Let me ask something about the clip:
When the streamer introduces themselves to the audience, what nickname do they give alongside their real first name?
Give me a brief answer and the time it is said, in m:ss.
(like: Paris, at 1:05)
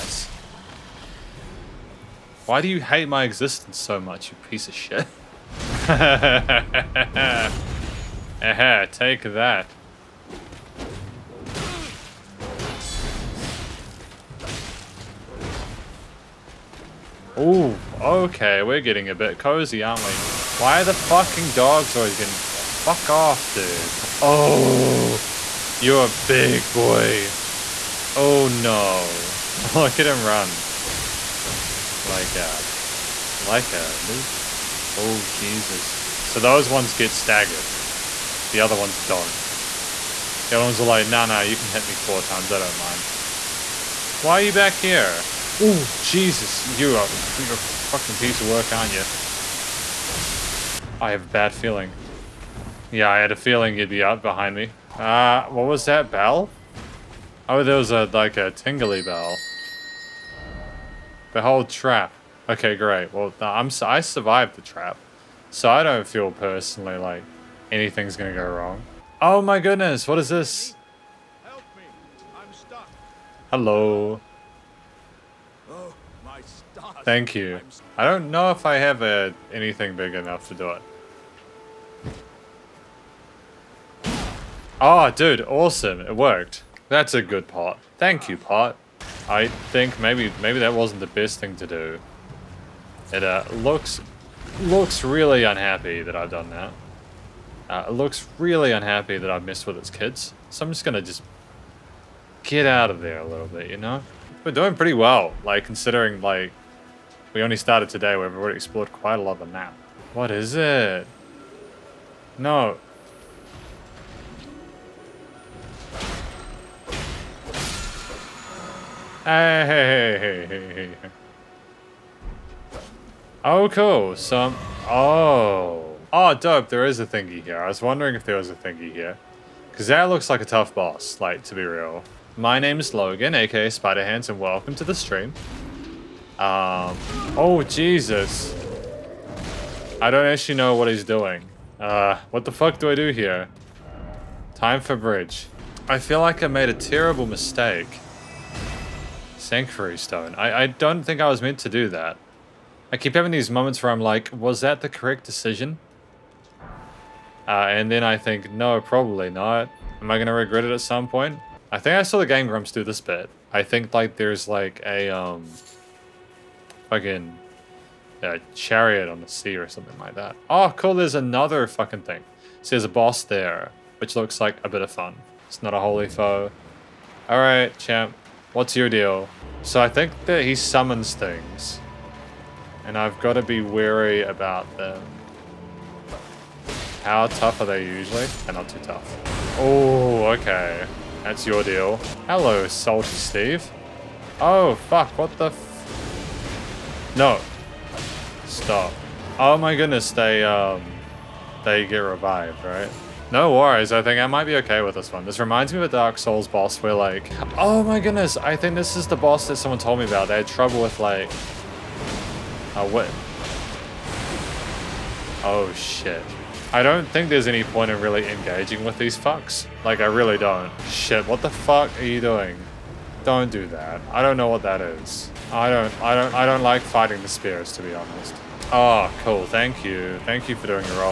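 Spider Hands, at 2:13.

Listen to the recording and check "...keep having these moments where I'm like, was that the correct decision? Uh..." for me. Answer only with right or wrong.
right.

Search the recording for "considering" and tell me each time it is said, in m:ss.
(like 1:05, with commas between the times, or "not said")
1:45.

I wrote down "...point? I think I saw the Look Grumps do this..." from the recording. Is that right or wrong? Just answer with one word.
wrong.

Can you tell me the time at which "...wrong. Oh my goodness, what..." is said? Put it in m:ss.
1:08.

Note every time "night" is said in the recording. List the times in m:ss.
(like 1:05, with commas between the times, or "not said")
not said.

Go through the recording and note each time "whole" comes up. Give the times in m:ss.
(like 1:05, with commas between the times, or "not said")
1:01.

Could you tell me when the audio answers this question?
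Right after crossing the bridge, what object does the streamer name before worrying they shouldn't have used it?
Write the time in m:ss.
2:29.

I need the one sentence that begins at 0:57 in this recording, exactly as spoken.
Oh, there was a, like, a tingly bell.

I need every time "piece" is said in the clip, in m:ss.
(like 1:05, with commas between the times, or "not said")
0:04, 0:48.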